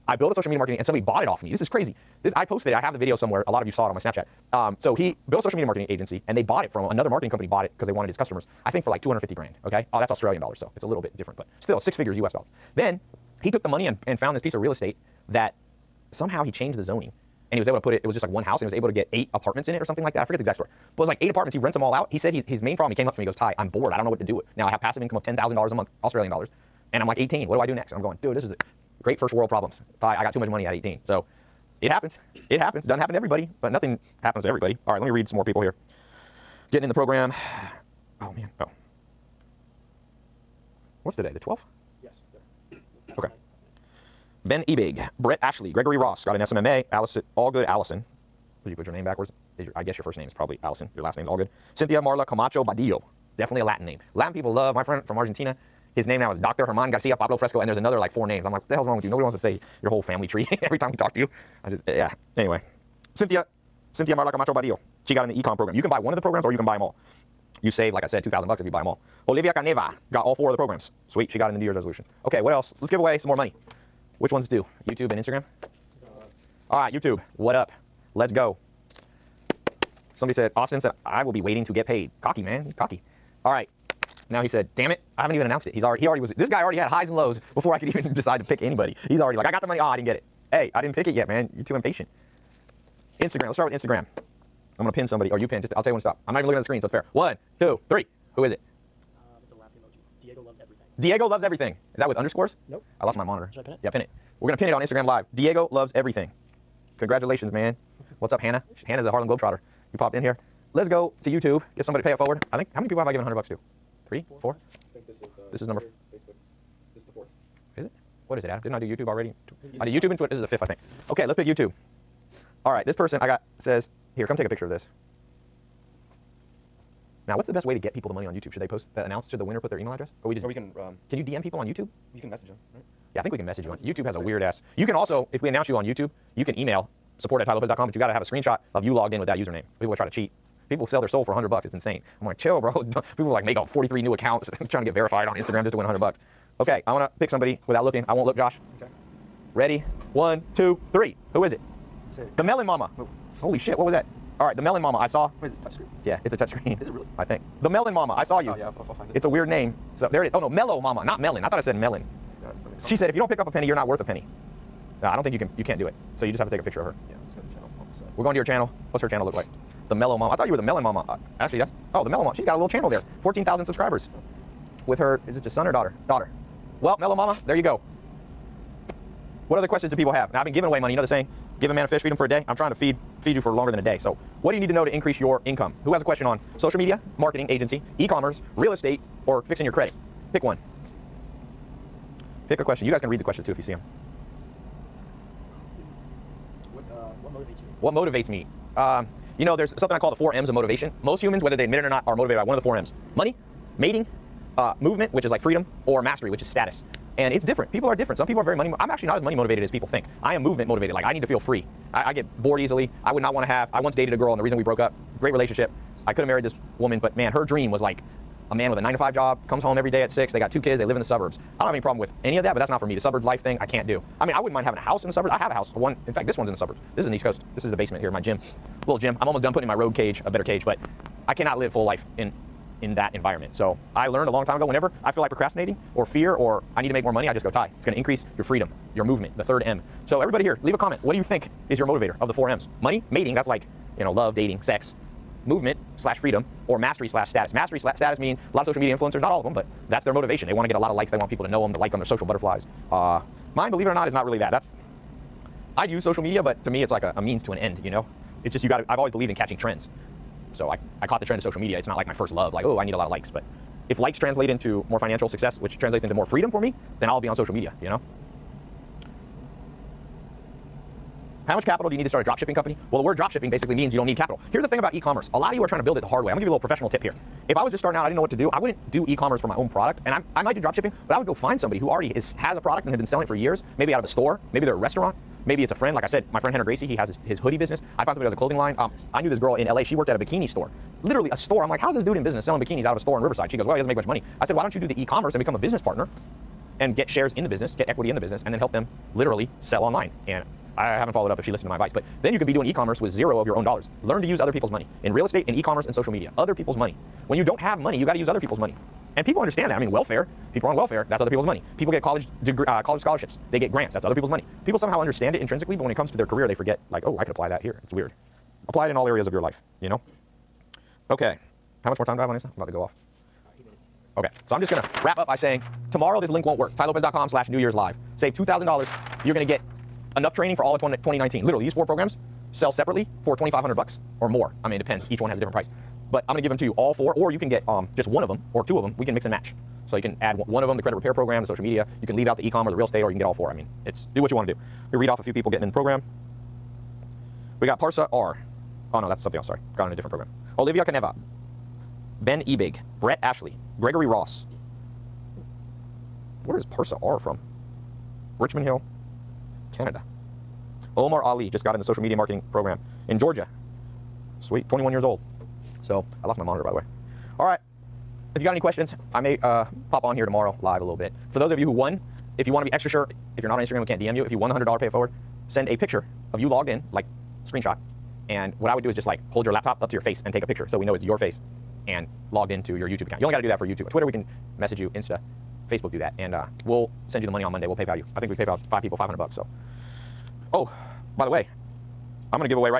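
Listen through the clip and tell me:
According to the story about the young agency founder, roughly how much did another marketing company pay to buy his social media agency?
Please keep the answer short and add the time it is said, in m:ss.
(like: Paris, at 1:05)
250 grand, at 0:09.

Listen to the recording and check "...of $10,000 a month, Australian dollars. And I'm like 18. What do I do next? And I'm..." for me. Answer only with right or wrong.
right.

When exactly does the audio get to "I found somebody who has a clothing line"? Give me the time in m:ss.
4:47.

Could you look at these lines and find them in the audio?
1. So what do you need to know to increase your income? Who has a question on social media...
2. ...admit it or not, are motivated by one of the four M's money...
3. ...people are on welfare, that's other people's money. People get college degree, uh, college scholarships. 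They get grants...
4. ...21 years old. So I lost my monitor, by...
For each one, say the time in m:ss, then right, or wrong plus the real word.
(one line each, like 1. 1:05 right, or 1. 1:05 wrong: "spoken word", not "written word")
1. 3:03 right
2. 3:21 right
3. 5:10 right
4. 6:04 right.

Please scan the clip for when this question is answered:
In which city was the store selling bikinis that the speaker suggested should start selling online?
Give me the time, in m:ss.
4:53.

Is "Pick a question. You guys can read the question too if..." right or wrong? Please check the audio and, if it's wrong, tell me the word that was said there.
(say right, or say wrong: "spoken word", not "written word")
right.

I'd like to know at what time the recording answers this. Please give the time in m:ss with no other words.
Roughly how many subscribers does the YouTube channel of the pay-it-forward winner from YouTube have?
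2:53.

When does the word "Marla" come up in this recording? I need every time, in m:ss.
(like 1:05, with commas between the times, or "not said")
0:52, 1:04.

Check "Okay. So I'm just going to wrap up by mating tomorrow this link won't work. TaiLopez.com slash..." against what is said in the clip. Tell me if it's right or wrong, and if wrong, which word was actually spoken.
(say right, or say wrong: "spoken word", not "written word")
wrong: "saying", not "mating".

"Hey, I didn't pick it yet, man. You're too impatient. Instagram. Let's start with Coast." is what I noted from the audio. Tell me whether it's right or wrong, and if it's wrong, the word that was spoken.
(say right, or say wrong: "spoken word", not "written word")
wrong: "Instagram", not "Coast".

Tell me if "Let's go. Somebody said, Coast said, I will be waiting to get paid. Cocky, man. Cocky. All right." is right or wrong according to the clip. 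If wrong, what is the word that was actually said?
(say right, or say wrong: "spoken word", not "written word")
wrong: "Austin", not "Coast".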